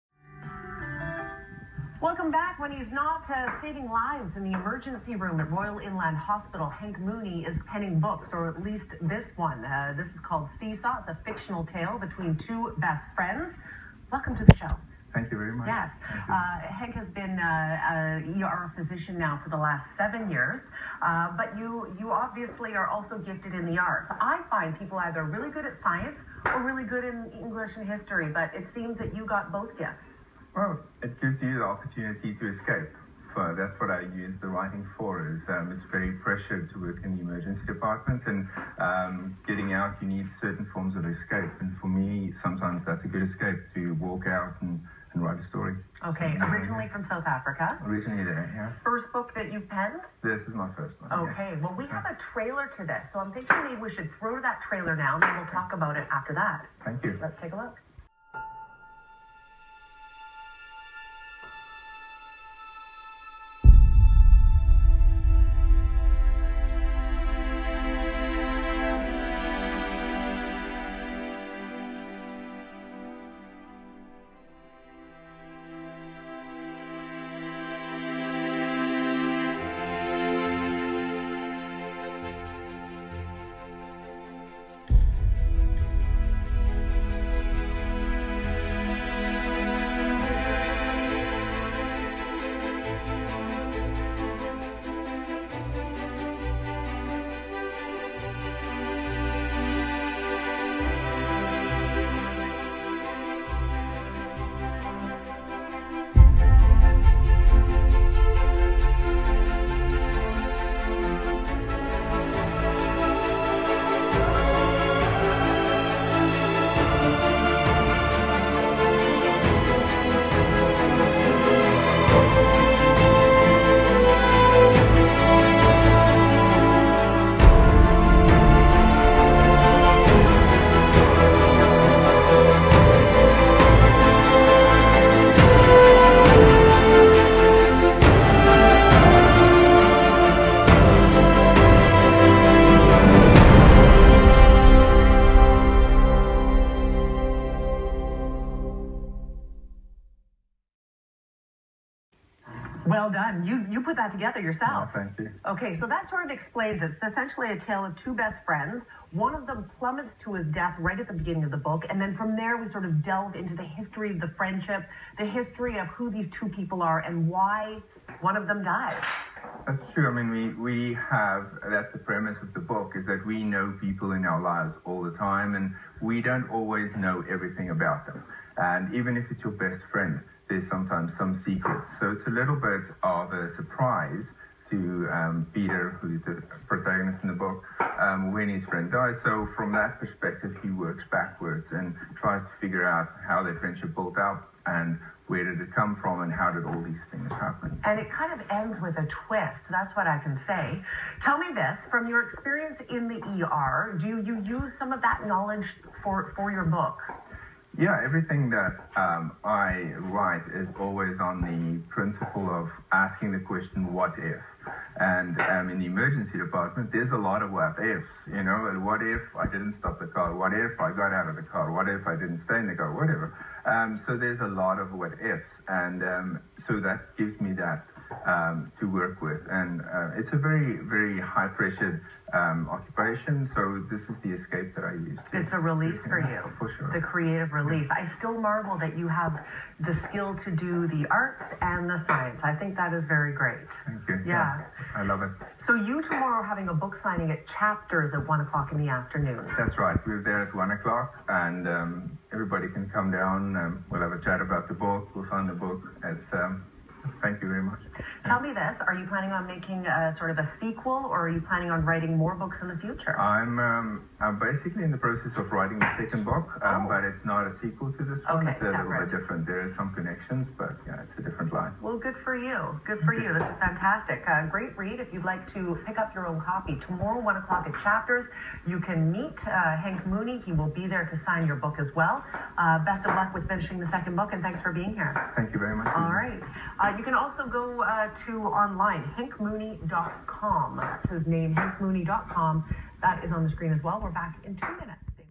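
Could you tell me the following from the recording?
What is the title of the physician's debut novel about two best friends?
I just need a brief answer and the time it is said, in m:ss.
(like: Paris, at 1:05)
Seesaw, at 0:10.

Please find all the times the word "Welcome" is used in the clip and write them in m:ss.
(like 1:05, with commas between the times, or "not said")
0:02, 0:14.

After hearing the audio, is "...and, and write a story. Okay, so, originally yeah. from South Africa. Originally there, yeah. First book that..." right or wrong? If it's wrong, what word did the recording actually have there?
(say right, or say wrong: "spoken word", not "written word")
right.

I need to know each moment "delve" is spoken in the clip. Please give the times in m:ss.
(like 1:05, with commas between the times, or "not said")
2:43.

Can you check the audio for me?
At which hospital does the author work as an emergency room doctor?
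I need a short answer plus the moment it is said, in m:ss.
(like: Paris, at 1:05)
Royal Inland Hospital, at 0:05.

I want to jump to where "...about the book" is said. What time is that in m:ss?
4:14.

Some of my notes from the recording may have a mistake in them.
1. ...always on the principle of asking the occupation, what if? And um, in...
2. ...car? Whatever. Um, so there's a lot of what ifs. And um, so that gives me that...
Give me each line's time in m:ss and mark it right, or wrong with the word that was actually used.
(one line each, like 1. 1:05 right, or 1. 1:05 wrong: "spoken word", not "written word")
1. 3:30 wrong: "question", not "occupation"
2. 3:42 right.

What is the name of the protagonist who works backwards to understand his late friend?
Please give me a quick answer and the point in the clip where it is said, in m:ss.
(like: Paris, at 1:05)
Peter, at 3:05.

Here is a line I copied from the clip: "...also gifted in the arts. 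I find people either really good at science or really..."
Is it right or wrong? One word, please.
right.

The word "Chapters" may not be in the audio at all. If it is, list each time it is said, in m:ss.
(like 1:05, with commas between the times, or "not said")
4:07, 4:37.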